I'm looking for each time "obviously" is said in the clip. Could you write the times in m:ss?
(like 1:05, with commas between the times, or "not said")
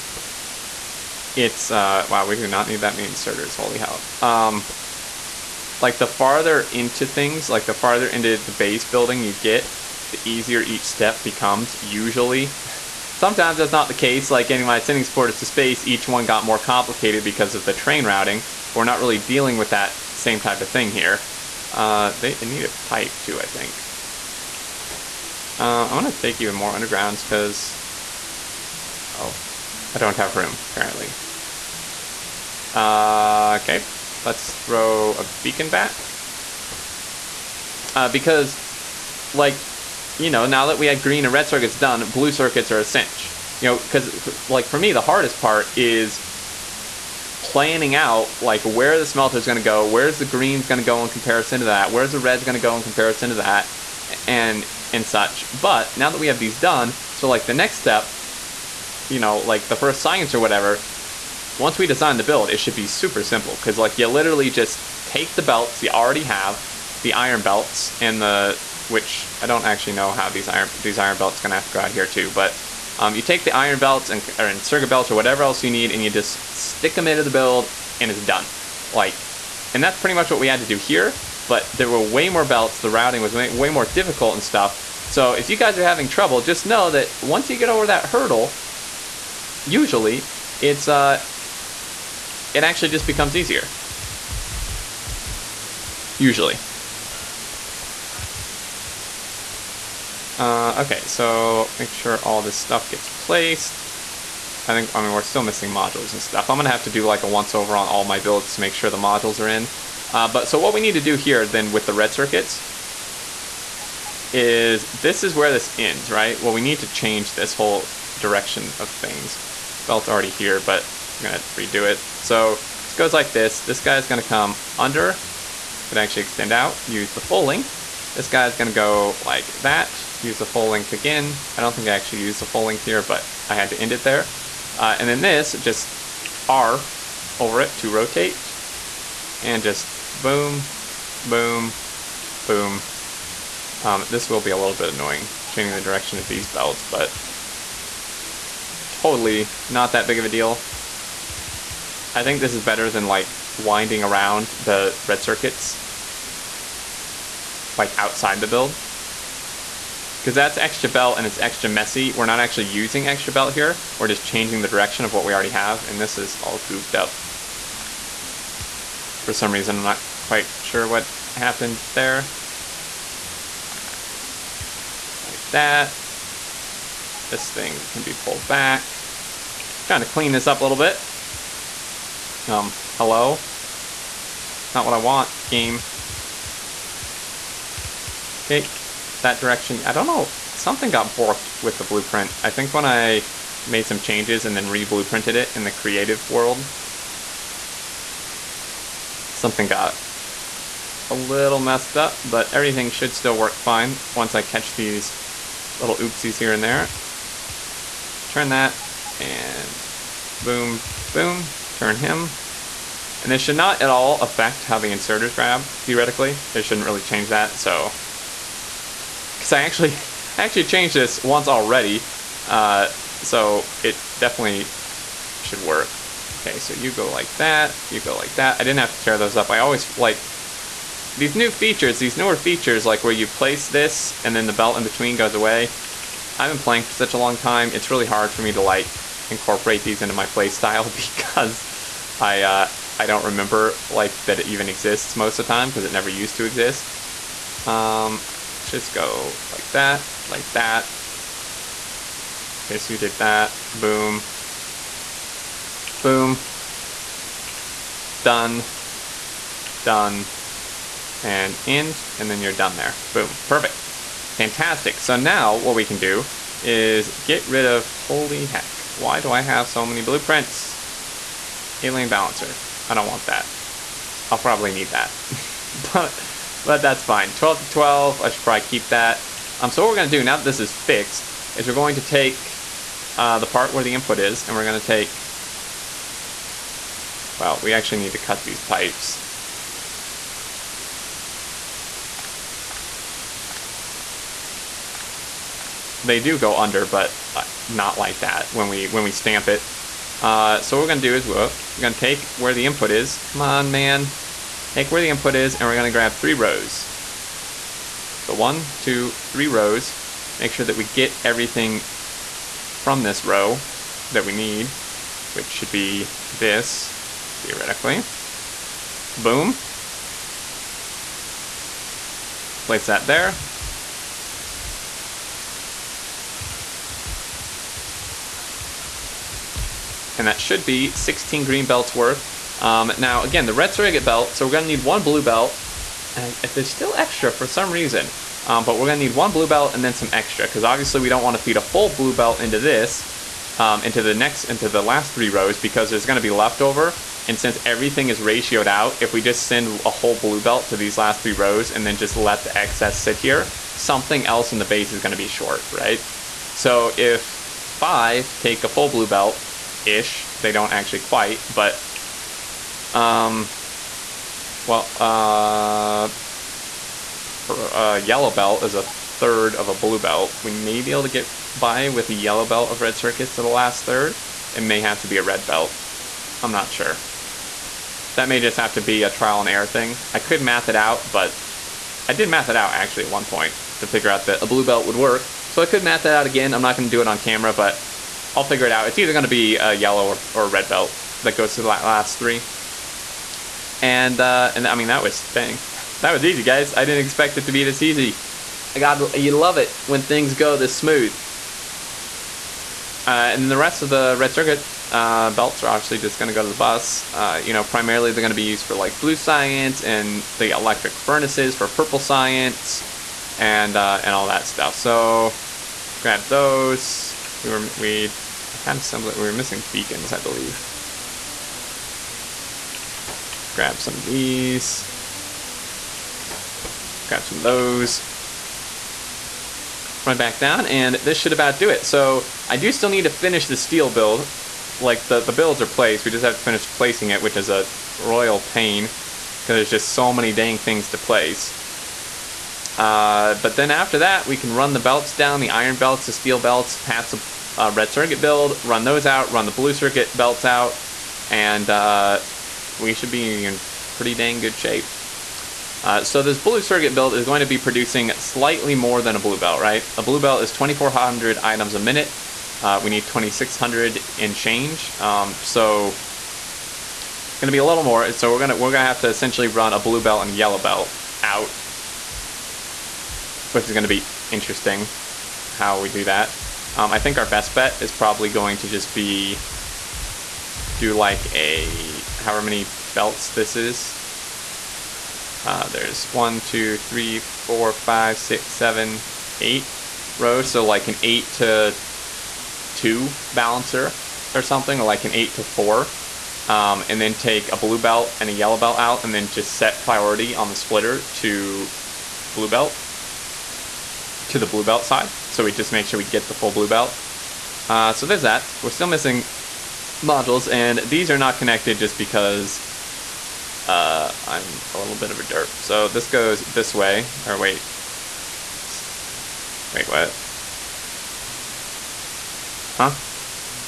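5:40, 6:45.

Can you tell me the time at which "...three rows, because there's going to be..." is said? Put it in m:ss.
5:45.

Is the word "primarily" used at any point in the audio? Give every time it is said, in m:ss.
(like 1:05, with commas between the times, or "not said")
6:47.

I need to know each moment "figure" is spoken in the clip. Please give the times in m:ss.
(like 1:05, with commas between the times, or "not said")
6:23, 6:28.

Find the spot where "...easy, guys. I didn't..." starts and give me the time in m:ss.
6:36.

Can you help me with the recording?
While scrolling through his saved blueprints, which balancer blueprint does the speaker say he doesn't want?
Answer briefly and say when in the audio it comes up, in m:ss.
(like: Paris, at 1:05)
Alien Balancer, at 4:31.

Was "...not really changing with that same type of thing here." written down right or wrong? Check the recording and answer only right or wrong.
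wrong.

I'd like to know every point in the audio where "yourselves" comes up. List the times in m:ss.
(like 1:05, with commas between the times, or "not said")
not said.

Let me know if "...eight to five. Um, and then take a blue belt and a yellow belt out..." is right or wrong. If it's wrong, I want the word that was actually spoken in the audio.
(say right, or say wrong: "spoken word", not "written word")
wrong: "four", not "five".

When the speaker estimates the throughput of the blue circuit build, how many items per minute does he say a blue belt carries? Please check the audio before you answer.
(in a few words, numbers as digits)
2,400.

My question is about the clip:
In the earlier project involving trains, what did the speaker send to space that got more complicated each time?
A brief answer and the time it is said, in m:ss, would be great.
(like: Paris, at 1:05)
supporters, at 0:15.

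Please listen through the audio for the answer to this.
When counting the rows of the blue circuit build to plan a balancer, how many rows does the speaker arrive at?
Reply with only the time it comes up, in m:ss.
8:09.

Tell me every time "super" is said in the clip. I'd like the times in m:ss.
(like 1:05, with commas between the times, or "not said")
1:02.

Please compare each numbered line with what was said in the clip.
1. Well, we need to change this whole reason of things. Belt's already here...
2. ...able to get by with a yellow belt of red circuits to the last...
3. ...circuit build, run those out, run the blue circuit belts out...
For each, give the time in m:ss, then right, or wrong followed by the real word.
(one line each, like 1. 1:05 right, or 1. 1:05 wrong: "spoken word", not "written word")
1. 1:56 wrong: "direction", not "reason"
2. 6:10 right
3. 7:27 right.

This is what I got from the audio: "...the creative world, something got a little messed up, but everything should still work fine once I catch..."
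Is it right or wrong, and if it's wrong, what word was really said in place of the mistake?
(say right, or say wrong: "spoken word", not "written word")
right.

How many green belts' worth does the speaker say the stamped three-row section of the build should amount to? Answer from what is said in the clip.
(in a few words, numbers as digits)
16.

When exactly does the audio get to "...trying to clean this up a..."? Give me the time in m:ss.
2:59.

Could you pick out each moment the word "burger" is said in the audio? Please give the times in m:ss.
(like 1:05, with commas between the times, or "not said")
not said.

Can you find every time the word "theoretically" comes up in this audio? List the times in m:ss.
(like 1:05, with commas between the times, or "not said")
3:35, 5:17.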